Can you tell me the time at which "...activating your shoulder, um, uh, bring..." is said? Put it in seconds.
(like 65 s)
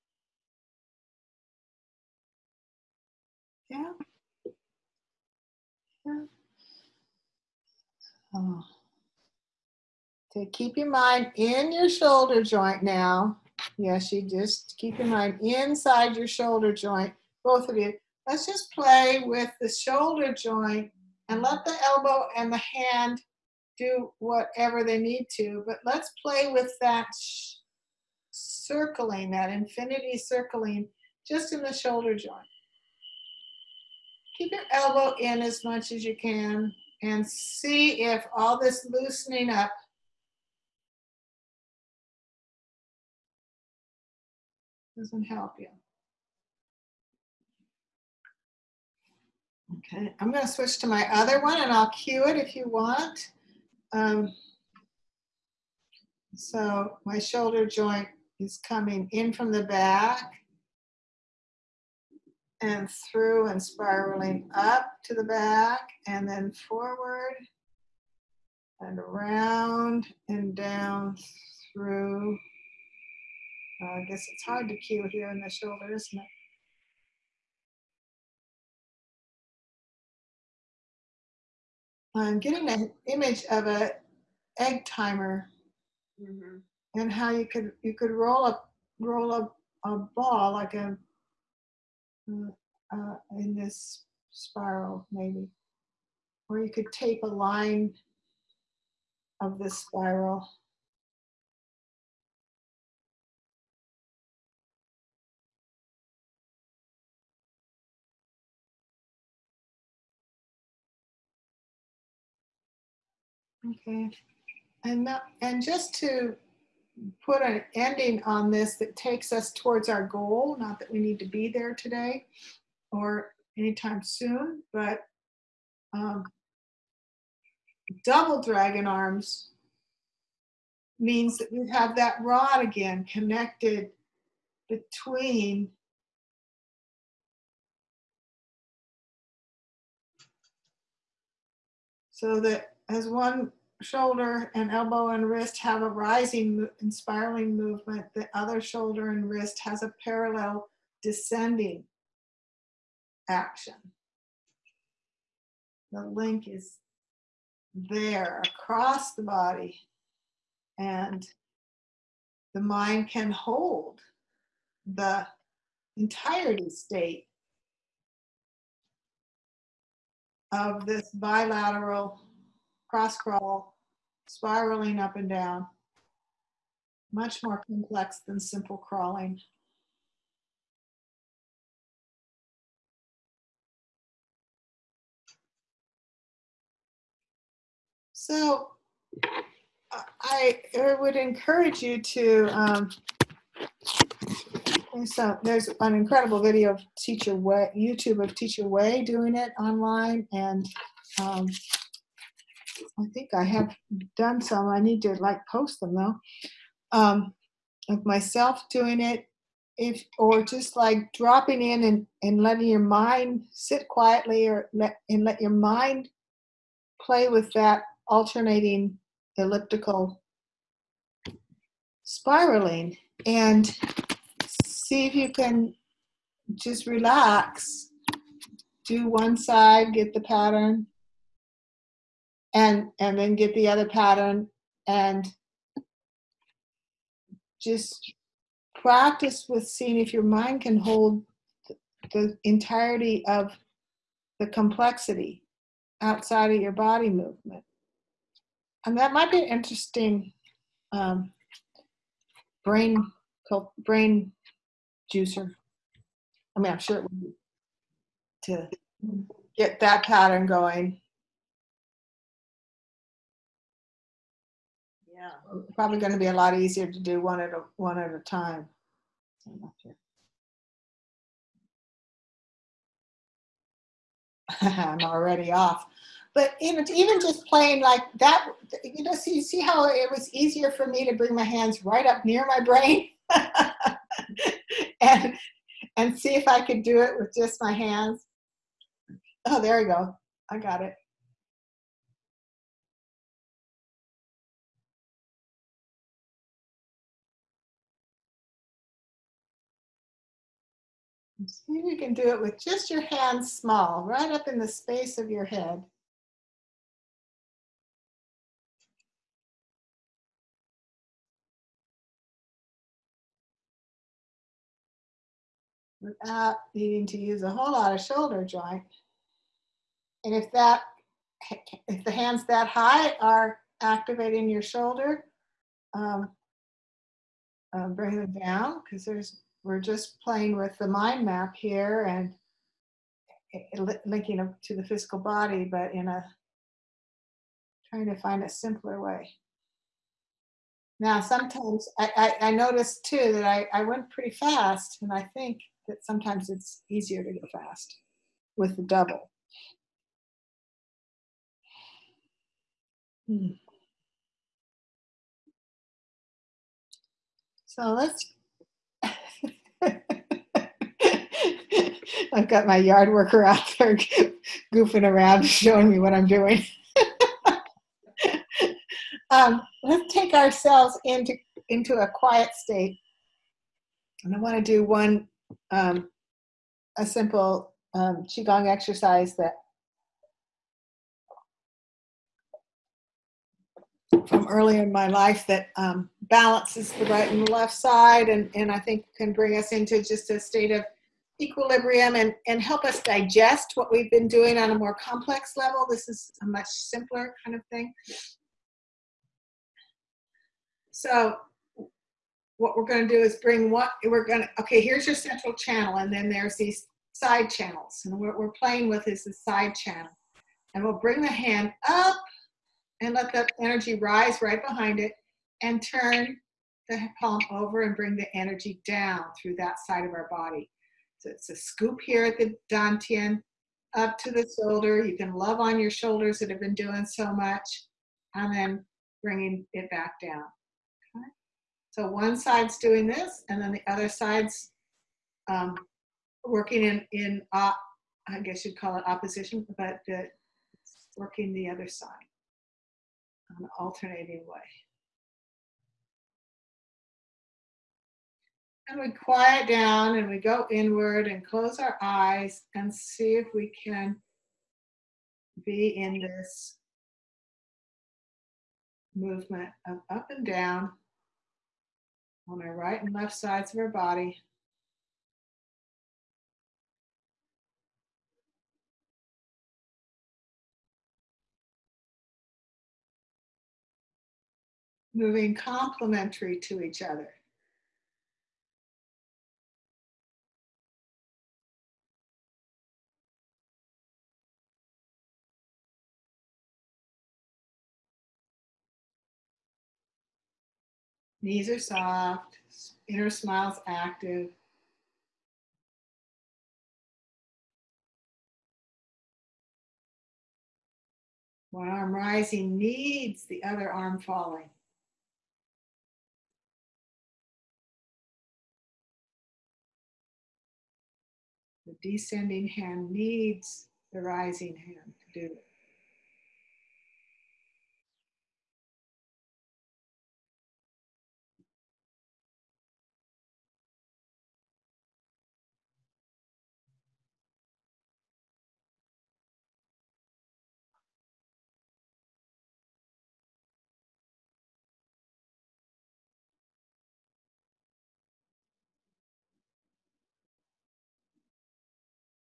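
323 s.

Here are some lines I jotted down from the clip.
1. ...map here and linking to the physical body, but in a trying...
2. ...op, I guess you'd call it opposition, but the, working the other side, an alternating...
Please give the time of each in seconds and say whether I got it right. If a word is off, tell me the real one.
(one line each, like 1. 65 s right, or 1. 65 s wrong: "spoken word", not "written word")
1. 331 s right
2. 437 s right.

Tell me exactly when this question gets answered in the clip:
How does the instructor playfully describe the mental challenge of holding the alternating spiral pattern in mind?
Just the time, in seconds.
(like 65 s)
252 s.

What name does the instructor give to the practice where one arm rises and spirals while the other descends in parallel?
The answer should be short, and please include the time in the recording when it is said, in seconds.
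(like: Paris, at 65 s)
double dragon arms, at 128 s.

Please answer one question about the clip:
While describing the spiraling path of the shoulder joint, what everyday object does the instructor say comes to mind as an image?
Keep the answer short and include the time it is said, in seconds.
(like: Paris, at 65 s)
egg timer, at 84 s.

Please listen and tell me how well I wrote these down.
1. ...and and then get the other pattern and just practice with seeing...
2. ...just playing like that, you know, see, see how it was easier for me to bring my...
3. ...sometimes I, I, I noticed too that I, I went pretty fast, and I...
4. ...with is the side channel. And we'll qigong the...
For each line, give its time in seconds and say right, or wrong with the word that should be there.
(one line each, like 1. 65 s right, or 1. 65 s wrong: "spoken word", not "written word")
1. 232 s right
2. 277 s right
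3. 341 s right
4. 408 s wrong: "bring", not "qigong".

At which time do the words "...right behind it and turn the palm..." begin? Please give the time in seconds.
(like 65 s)
414 s.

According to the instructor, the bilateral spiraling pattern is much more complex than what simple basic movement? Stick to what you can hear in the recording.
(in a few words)
crawling.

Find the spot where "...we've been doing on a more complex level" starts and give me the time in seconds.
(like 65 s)
393 s.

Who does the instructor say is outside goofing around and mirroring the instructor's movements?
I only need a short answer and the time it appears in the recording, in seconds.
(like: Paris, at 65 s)
yard worker, at 362 s.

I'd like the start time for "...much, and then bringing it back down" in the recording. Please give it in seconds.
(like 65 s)
427 s.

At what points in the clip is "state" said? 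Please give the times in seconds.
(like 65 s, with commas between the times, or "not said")
166 s, 372 s, 390 s.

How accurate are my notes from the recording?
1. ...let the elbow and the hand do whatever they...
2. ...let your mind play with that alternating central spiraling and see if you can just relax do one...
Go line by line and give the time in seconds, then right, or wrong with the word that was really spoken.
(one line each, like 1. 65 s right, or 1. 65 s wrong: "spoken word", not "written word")
1. 21 s right
2. 215 s wrong: "elliptical", not "central".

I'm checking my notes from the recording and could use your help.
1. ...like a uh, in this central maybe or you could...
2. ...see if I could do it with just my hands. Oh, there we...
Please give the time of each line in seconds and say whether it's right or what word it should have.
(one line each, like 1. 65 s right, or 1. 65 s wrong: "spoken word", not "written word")
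1. 90 s wrong: "spiral", not "central"
2. 286 s right.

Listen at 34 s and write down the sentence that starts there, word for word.
Keep your elbow in as much as you can and see if all this loosening up doesn't help you.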